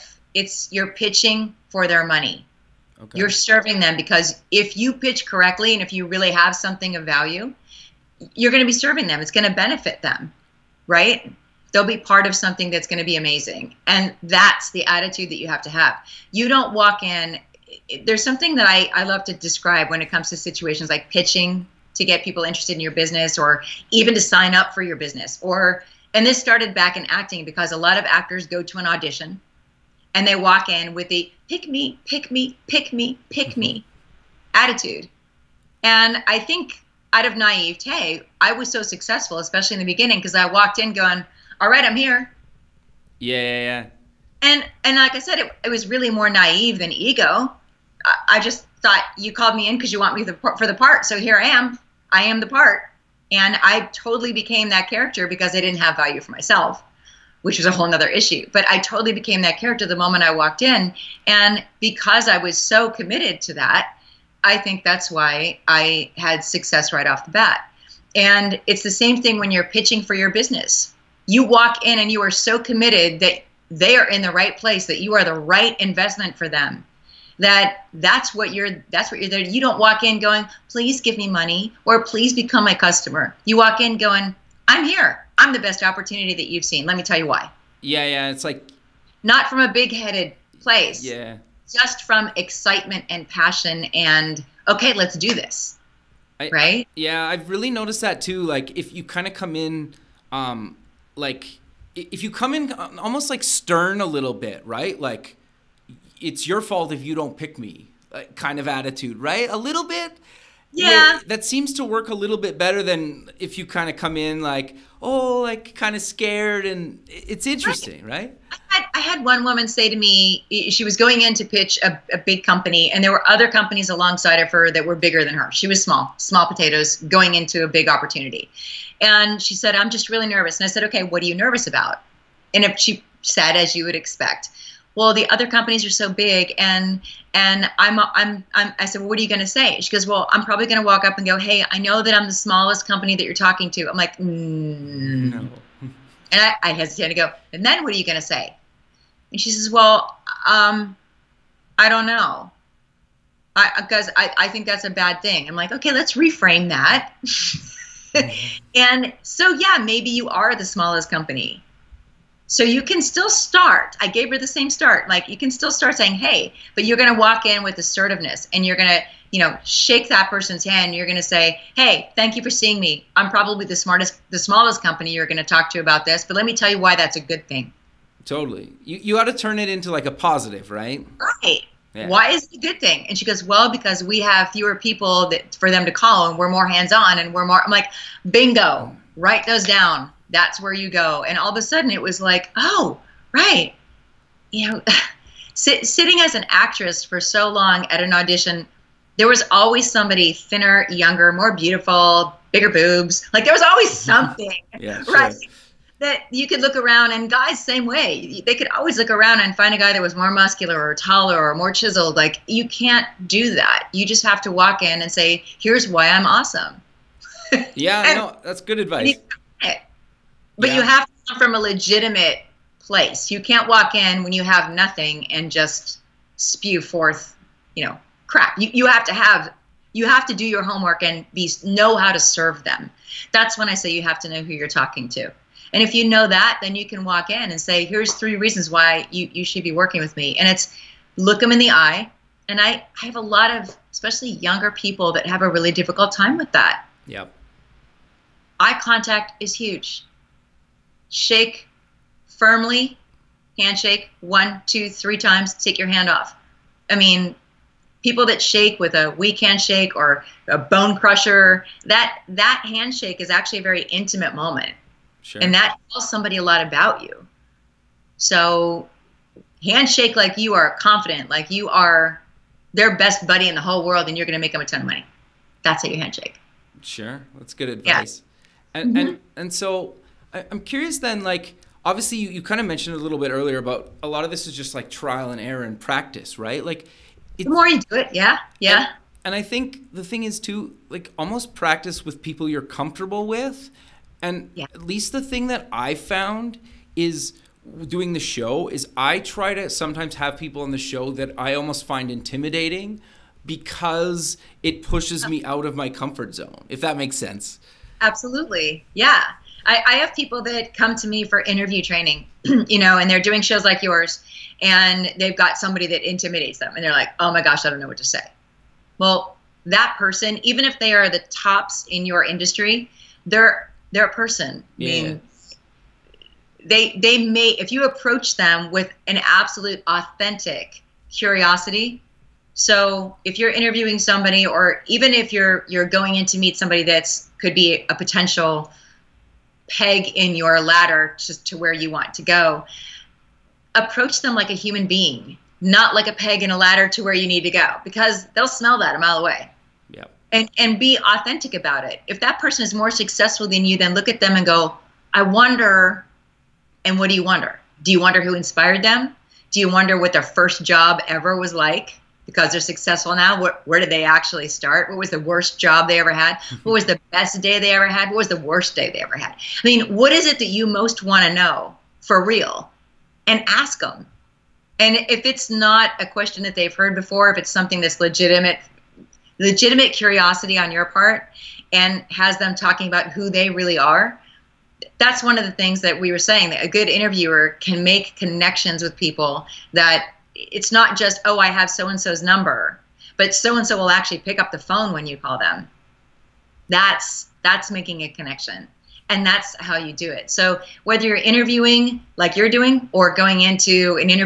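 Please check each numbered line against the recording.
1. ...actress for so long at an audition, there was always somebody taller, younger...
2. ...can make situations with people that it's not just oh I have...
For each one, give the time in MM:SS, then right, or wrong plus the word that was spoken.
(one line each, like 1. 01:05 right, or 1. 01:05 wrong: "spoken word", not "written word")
1. 03:16 wrong: "thinner", not "taller"
2. 06:27 wrong: "connections", not "situations".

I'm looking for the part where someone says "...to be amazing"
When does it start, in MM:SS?
00:12.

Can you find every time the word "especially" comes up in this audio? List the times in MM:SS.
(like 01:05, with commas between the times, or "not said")
00:39, 04:03.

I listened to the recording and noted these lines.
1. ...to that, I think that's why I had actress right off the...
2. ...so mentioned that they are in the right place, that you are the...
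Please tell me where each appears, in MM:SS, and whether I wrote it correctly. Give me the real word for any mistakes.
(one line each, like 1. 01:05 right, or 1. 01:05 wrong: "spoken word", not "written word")
1. 01:03 wrong: "success", not "actress"
2. 01:12 wrong: "committed", not "mentioned".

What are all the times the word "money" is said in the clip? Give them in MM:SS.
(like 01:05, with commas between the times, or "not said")
00:02, 01:21, 04:34.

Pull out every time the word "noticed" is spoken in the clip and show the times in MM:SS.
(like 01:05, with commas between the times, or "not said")
01:37.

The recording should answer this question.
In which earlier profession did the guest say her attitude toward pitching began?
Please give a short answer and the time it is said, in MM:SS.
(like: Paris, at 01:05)
acting, at 00:27.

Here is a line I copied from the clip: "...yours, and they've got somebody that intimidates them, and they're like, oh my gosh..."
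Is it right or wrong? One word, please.
right.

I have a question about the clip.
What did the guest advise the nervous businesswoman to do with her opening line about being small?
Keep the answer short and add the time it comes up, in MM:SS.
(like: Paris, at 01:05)
reframe that, at 02:36.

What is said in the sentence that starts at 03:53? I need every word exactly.
That's when I say you have to know who you're talking to.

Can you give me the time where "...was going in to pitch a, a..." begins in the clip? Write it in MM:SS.
02:00.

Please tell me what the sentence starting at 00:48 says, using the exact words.
I, I just thought you called me in because you want me the, for the part.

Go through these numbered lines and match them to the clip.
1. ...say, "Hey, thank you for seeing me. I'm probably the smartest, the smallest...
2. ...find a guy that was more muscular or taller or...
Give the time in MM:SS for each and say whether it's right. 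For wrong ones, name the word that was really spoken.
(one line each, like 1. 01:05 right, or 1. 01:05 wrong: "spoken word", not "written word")
1. 02:51 right
2. 03:29 right.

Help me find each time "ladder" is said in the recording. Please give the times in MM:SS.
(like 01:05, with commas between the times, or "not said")
05:40, 05:46.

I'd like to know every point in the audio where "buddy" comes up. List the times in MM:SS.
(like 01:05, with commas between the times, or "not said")
04:33.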